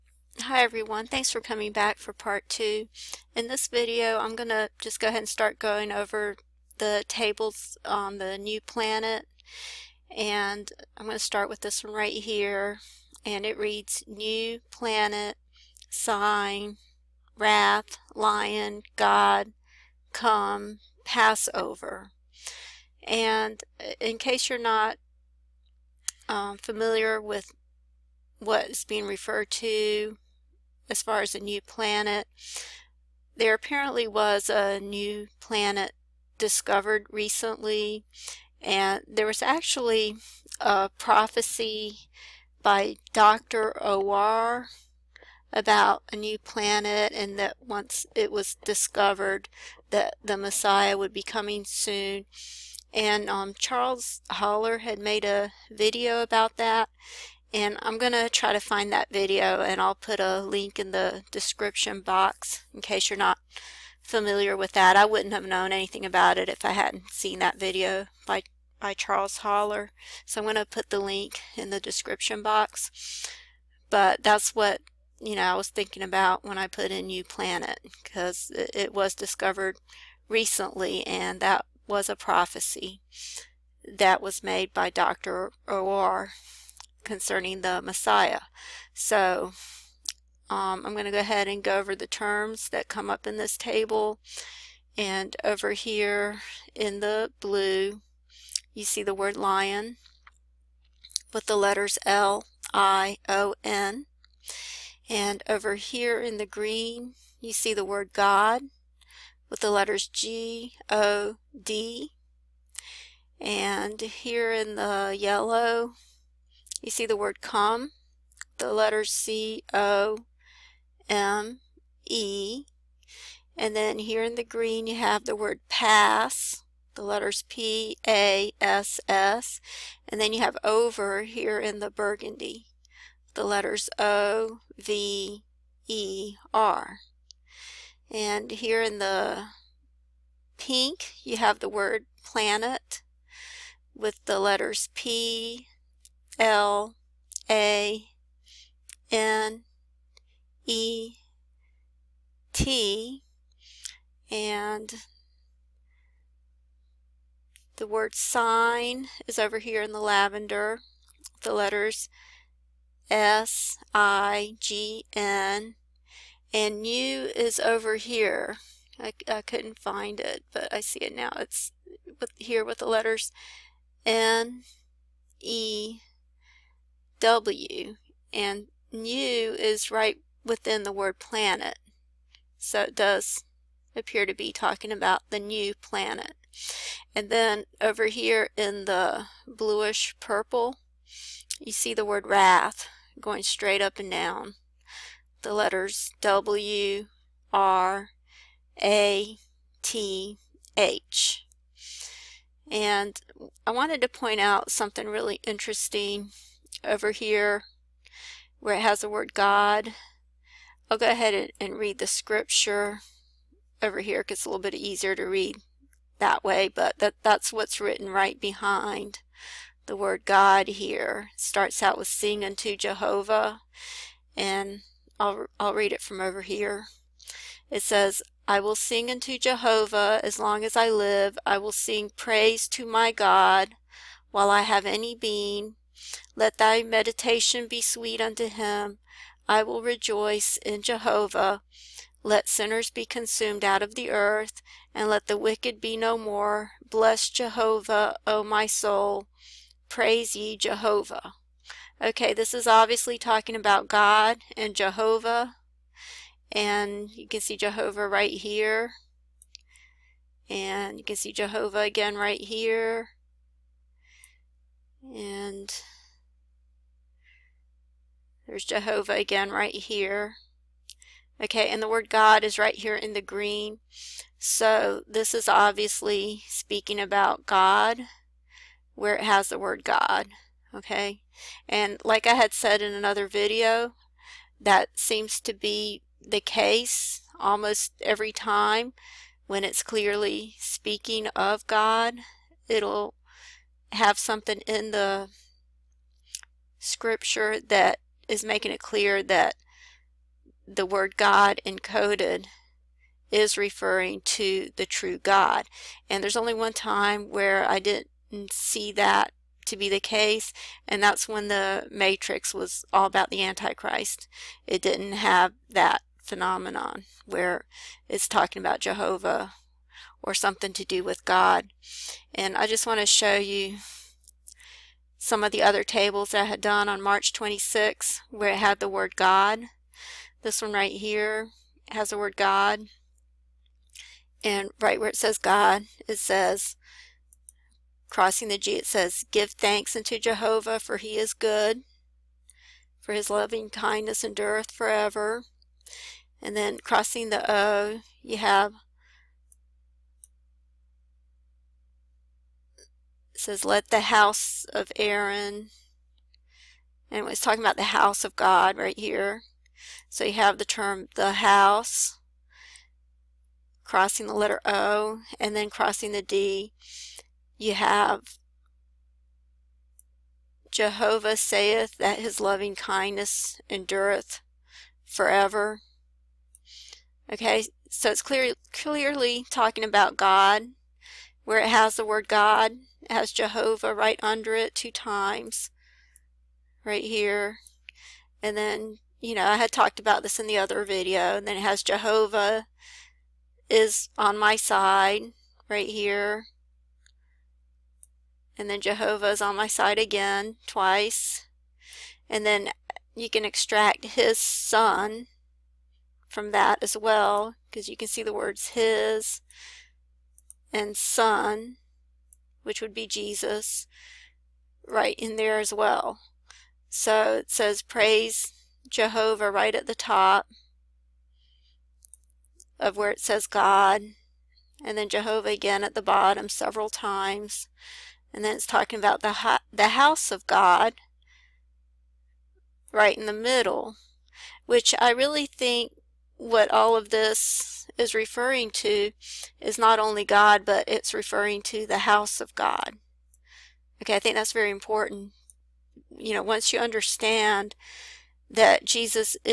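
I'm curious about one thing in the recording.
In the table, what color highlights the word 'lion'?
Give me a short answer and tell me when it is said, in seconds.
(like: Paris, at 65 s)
Blue, at 97 s.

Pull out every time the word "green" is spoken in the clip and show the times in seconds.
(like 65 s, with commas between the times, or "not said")
106 s, 124 s, 273 s.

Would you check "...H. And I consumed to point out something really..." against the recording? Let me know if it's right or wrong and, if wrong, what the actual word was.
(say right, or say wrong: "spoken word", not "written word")
wrong: "wanted", not "consumed".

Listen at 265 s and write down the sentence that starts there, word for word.
And there's Jehovah again right here.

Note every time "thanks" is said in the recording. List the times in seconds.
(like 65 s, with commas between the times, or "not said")
1 s, 339 s.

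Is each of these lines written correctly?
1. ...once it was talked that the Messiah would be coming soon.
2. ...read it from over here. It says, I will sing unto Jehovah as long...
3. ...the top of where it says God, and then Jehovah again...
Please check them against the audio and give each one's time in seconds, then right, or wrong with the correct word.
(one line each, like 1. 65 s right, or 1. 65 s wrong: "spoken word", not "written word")
1. 47 s wrong: "discovered", not "talked"
2. 225 s right
3. 419 s right.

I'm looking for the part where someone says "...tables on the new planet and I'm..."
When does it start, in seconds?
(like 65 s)
7 s.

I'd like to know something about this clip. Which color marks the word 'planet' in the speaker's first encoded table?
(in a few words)
Pink.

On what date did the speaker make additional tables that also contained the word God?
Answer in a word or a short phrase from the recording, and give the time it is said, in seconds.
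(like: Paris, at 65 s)
March 26, at 327 s.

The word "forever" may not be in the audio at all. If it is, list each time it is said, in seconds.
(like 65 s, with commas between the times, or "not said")
344 s, 375 s.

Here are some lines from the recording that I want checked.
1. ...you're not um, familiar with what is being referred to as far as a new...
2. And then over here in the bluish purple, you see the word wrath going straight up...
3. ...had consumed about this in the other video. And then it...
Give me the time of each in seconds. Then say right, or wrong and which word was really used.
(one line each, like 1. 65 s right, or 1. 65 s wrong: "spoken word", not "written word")
1. 24 s right
2. 187 s right
3. 389 s wrong: "talked", not "consumed".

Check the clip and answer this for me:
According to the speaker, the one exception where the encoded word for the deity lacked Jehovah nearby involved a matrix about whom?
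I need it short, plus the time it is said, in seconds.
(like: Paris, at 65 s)
The Antichrist, at 313 s.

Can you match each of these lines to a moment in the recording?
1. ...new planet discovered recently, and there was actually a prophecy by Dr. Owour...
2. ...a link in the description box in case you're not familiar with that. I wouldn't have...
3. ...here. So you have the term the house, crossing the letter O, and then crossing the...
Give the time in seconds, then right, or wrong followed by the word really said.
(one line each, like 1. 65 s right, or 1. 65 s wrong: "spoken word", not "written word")
1. 34 s right
2. 60 s right
3. 358 s right.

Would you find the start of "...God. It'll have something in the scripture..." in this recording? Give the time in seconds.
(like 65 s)
291 s.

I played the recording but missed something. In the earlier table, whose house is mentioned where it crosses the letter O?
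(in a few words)
Aaron.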